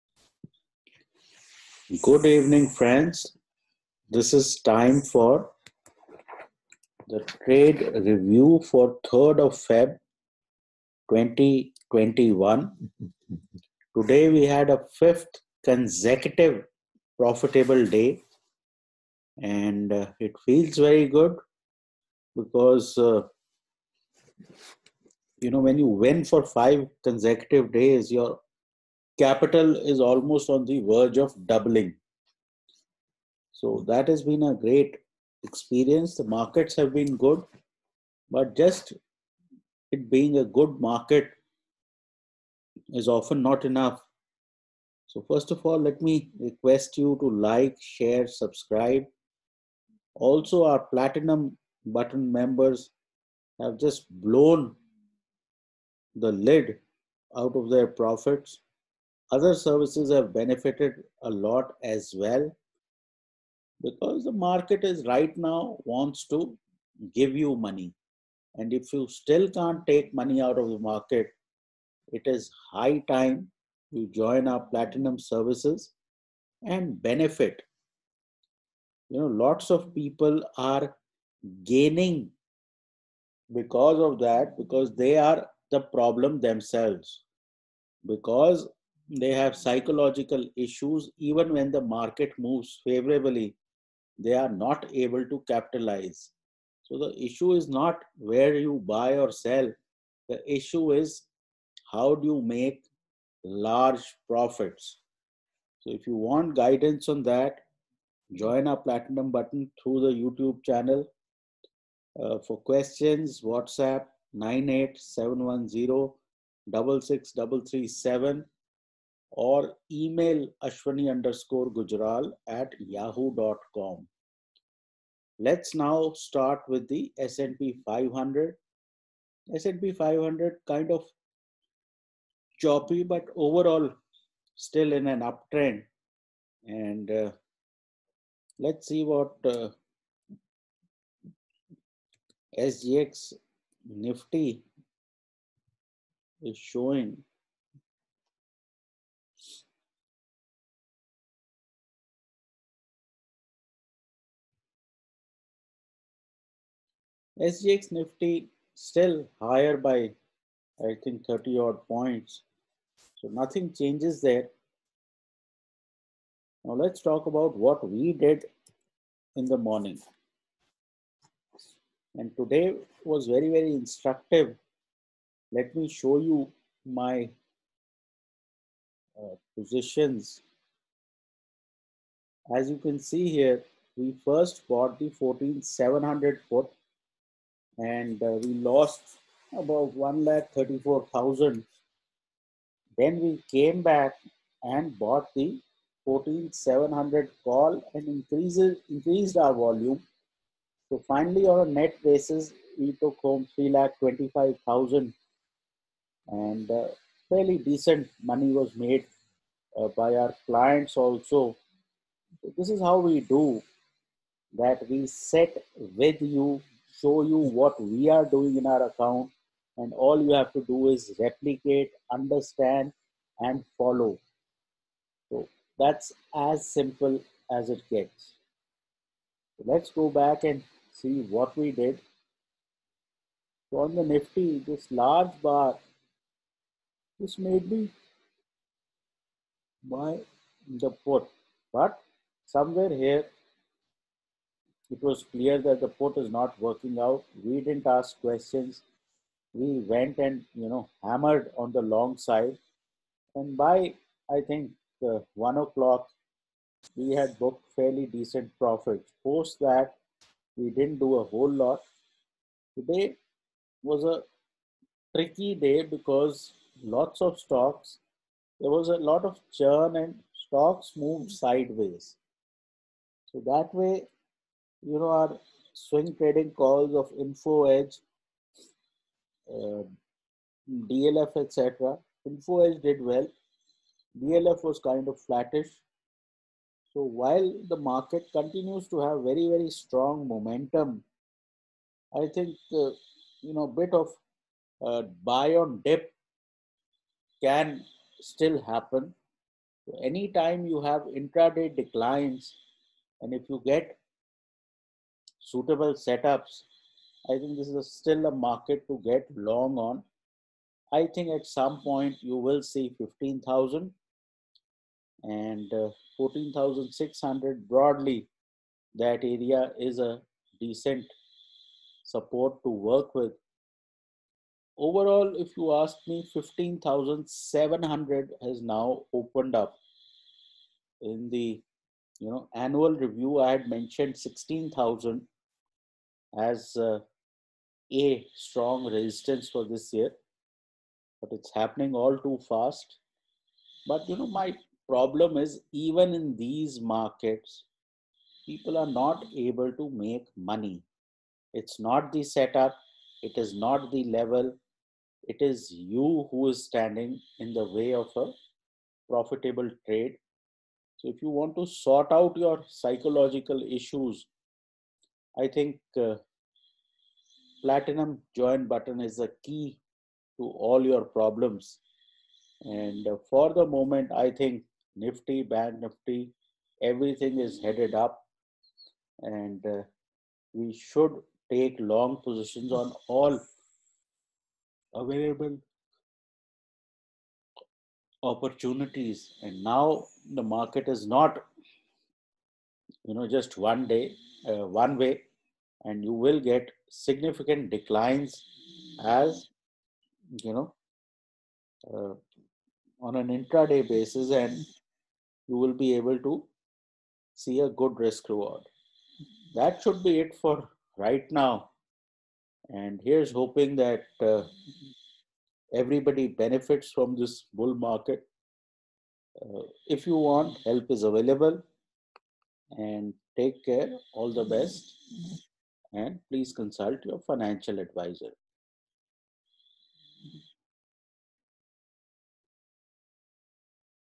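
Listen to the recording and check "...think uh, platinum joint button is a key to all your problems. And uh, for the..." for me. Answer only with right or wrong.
right.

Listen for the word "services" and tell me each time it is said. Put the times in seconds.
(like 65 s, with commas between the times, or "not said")
59 s, 75 s.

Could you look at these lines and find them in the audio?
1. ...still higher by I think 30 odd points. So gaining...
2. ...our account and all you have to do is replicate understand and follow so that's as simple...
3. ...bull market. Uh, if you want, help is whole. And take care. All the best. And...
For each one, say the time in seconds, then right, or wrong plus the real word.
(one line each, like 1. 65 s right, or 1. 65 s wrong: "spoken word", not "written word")
1. 158 s wrong: "nothing", not "gaining"
2. 218 s right
3. 417 s wrong: "available", not "whole".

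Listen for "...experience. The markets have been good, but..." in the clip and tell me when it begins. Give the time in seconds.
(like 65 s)
35 s.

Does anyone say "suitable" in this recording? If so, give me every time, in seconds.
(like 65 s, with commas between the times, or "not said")
305 s.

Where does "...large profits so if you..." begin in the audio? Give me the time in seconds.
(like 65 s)
103 s.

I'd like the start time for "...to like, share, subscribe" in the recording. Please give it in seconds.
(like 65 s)
47 s.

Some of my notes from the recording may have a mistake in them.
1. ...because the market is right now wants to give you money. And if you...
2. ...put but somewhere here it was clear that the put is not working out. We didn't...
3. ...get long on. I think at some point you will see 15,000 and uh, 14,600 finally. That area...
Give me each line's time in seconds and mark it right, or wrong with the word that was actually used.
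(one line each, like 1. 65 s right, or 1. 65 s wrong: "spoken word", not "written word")
1. 63 s right
2. 241 s right
3. 309 s wrong: "broadly", not "finally".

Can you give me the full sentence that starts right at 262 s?
Today was a tricky day because lots of stocks.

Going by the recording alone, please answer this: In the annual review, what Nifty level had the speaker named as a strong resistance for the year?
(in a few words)
16,000.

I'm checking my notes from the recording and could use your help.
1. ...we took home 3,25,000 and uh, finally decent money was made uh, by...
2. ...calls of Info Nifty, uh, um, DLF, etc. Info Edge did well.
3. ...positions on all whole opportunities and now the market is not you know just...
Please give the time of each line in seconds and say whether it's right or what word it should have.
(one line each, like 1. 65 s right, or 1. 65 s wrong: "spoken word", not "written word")
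1. 202 s wrong: "fairly", not "finally"
2. 276 s wrong: "Edge", not "Nifty"
3. 382 s wrong: "available", not "whole".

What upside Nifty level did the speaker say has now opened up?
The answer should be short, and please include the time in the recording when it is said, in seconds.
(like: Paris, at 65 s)
15,700, at 326 s.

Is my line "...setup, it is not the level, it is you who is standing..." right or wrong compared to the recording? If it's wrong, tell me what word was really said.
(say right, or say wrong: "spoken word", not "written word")
right.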